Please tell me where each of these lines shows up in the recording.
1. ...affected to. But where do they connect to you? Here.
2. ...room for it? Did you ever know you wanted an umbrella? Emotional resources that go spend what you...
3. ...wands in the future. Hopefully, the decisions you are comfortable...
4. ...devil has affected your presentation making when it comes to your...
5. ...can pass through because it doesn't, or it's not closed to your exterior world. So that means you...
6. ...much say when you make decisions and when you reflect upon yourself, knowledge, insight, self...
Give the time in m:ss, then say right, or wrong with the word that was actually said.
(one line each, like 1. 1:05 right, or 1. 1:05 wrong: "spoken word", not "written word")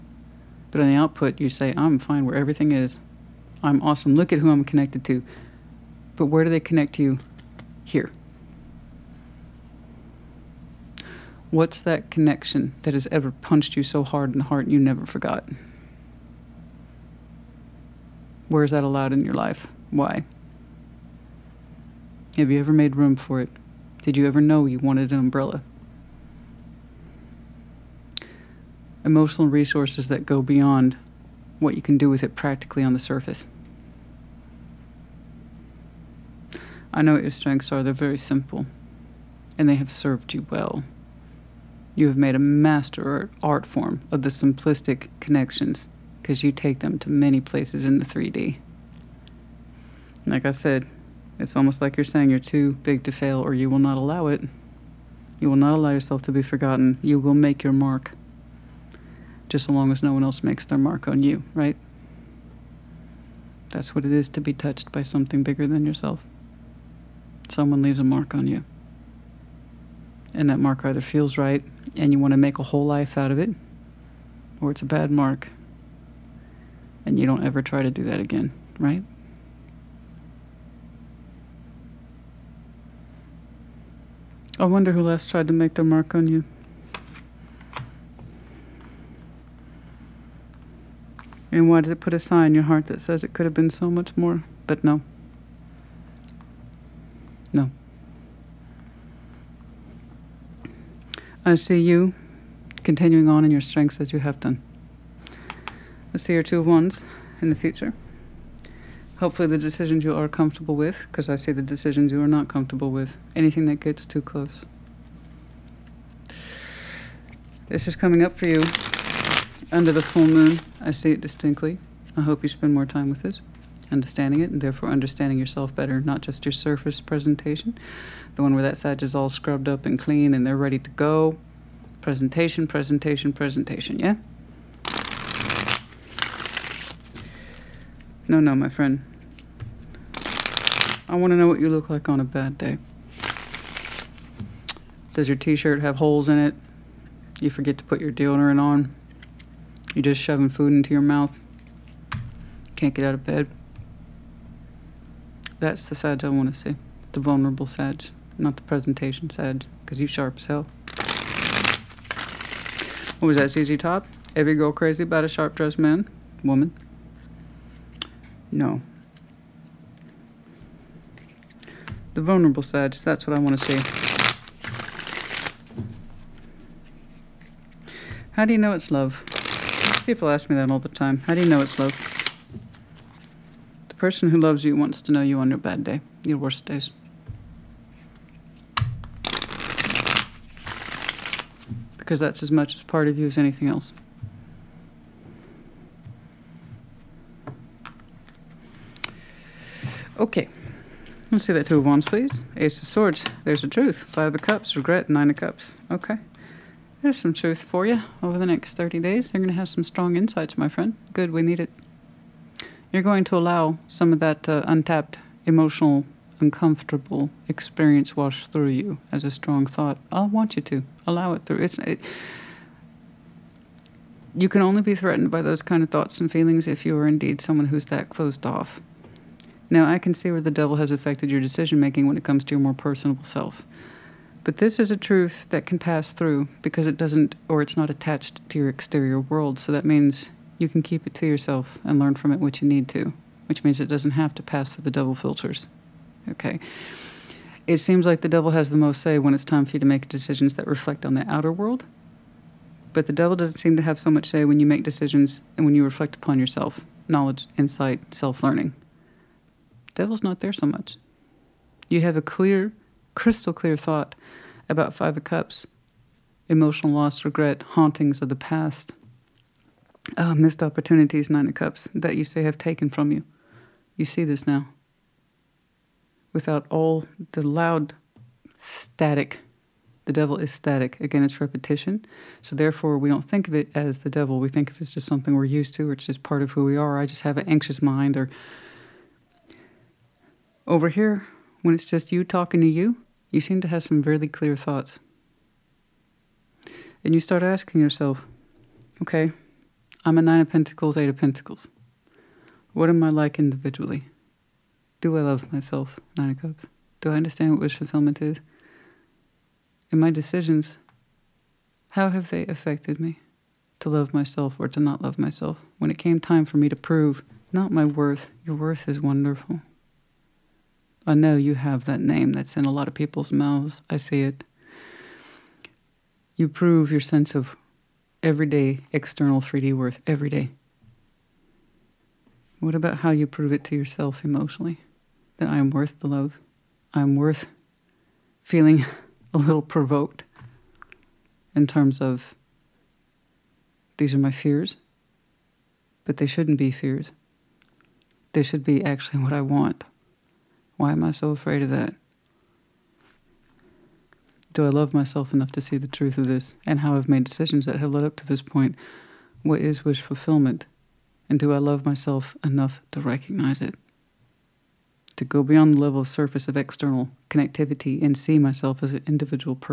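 1. 0:04 wrong: "connected", not "affected"
2. 0:22 wrong: "beyond", not "spend"
3. 1:46 right
4. 3:50 wrong: "decision", not "presentation"
5. 3:55 wrong: "attached", not "closed"
6. 4:14 right.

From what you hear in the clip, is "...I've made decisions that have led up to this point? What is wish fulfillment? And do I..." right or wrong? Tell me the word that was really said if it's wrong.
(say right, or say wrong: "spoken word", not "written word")
right.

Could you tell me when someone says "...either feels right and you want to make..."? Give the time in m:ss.
1:10.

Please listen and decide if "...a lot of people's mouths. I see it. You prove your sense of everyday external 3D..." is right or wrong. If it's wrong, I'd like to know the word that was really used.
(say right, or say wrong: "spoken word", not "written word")
right.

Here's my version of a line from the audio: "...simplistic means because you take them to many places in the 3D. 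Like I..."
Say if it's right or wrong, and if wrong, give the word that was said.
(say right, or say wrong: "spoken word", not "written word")
wrong: "connections", not "means".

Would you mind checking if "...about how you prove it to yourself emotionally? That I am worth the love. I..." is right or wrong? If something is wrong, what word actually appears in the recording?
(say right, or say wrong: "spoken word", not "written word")
right.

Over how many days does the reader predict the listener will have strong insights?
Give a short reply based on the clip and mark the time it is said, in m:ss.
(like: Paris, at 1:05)
30, at 3:28.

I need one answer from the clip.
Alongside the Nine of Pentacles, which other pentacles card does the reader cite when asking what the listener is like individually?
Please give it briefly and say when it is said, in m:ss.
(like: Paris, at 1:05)
Eight of Pentacles, at 5:00.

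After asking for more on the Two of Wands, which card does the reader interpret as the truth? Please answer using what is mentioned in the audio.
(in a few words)
Ace of Swords.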